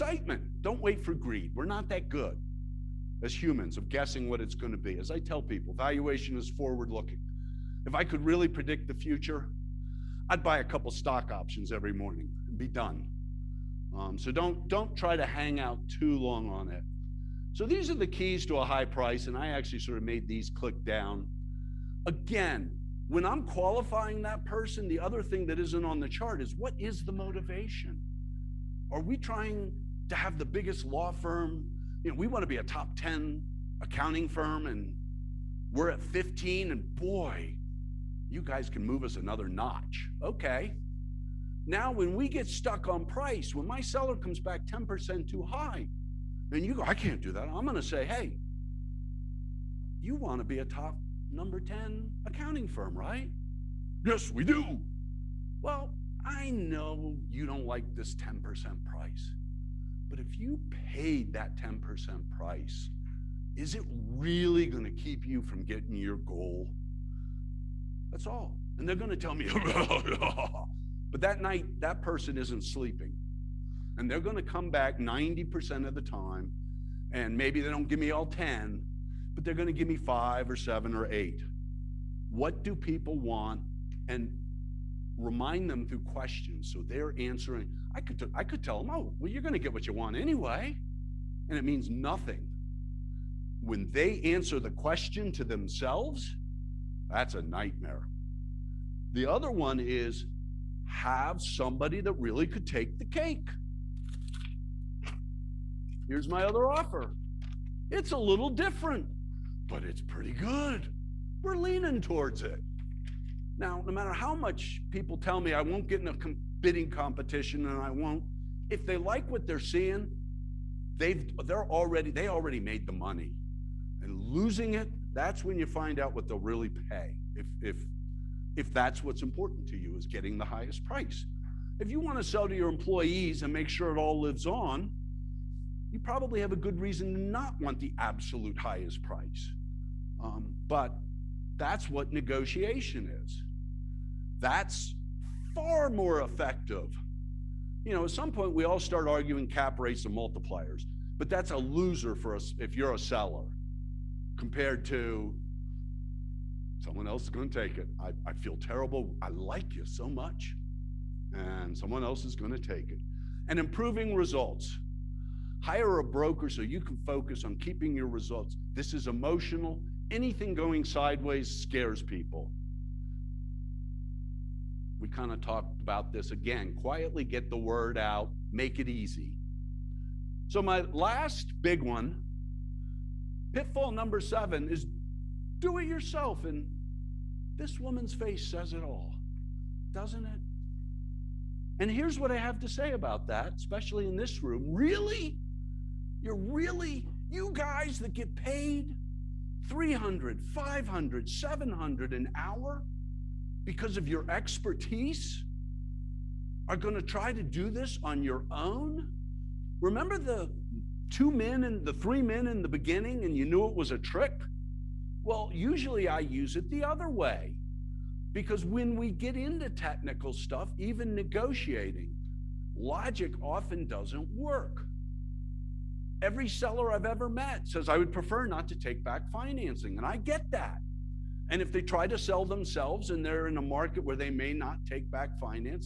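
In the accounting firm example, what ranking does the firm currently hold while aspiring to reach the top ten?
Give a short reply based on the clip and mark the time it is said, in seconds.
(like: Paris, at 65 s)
15, at 36 s.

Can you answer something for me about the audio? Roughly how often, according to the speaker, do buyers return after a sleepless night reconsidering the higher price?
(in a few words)
90% of the time.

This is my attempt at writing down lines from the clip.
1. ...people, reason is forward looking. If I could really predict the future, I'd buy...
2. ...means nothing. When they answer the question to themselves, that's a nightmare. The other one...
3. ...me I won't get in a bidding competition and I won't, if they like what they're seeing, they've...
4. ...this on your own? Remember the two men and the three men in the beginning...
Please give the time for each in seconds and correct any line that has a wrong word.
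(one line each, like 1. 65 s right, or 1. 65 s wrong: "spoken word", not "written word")
1. 5 s wrong: "valuation", not "reason"
2. 91 s right
3. 115 s right
4. 207 s right.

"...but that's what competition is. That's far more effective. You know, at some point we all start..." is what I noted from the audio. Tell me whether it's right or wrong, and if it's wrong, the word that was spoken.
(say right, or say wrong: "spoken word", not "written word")
wrong: "negotiation", not "competition".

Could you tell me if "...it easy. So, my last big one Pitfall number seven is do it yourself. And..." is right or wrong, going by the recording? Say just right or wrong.
right.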